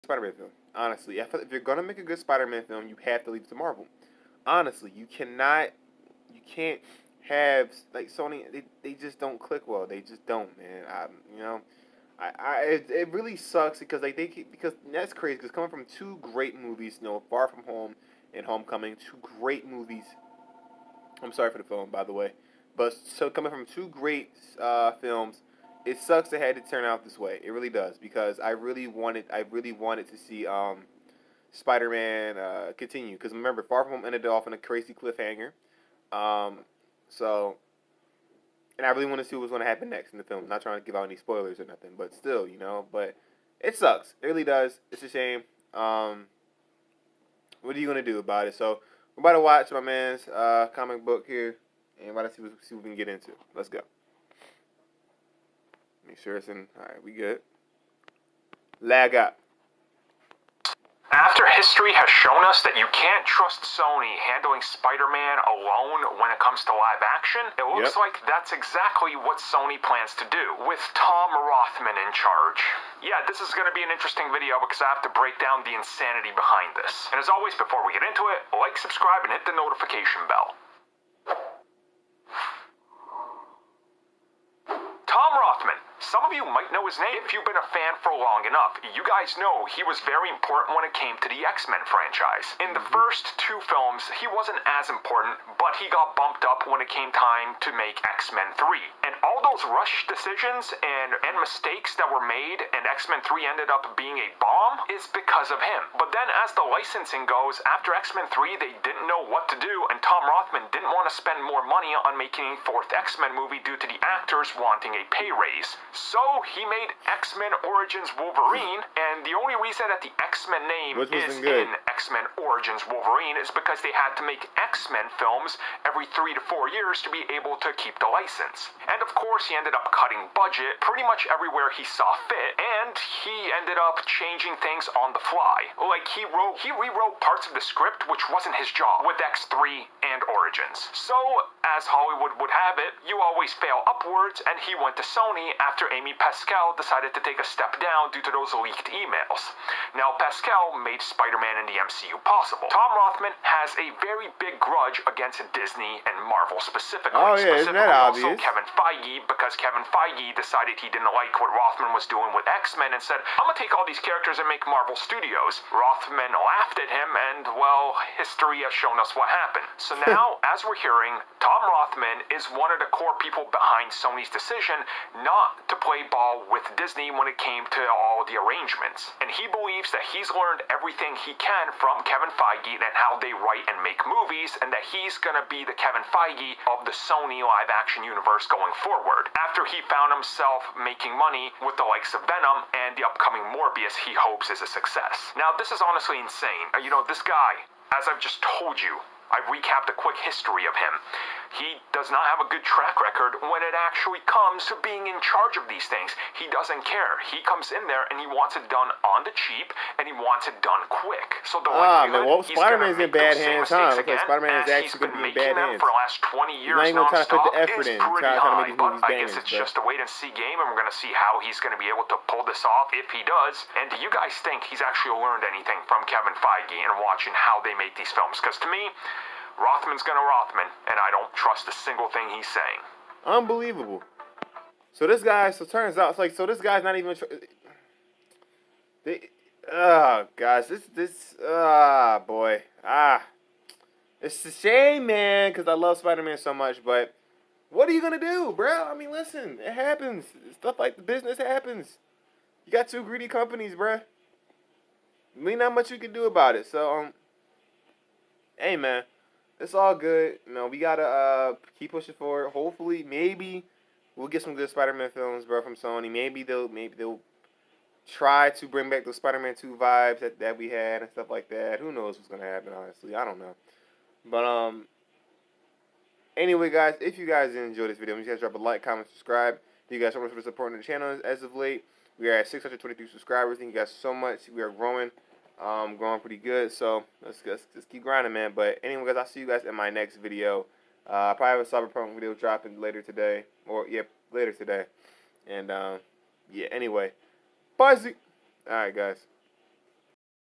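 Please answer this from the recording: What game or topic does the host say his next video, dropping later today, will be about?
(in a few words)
Cyberpunk.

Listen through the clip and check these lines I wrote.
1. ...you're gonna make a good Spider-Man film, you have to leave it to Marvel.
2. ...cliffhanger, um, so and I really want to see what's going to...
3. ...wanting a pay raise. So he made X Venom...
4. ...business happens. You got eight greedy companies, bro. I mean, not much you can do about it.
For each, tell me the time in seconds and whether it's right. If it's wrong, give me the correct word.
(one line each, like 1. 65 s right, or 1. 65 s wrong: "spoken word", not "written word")
1. 1 s right
2. 34 s right
3. 114 s wrong: "Men", not "Venom"
4. 251 s wrong: "two", not "eight".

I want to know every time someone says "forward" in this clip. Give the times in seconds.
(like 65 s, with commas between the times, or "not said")
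188 s, 262 s.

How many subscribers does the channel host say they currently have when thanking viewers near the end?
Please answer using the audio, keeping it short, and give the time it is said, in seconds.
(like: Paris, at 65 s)
623, at 282 s.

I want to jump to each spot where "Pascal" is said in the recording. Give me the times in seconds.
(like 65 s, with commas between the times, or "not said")
146 s, 150 s.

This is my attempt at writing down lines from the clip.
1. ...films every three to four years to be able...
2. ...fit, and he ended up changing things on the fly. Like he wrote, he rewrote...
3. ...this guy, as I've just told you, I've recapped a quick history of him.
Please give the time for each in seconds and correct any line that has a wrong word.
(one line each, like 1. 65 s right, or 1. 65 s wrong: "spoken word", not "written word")
1. 125 s right
2. 132 s right
3. 197 s right.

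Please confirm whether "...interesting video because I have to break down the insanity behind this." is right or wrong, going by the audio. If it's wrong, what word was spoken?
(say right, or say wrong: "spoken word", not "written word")
right.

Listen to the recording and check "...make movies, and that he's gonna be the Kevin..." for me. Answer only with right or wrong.
right.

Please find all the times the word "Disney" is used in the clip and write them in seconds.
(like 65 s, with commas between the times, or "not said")
155 s, 176 s.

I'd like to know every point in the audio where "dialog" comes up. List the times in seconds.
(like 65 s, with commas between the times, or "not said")
not said.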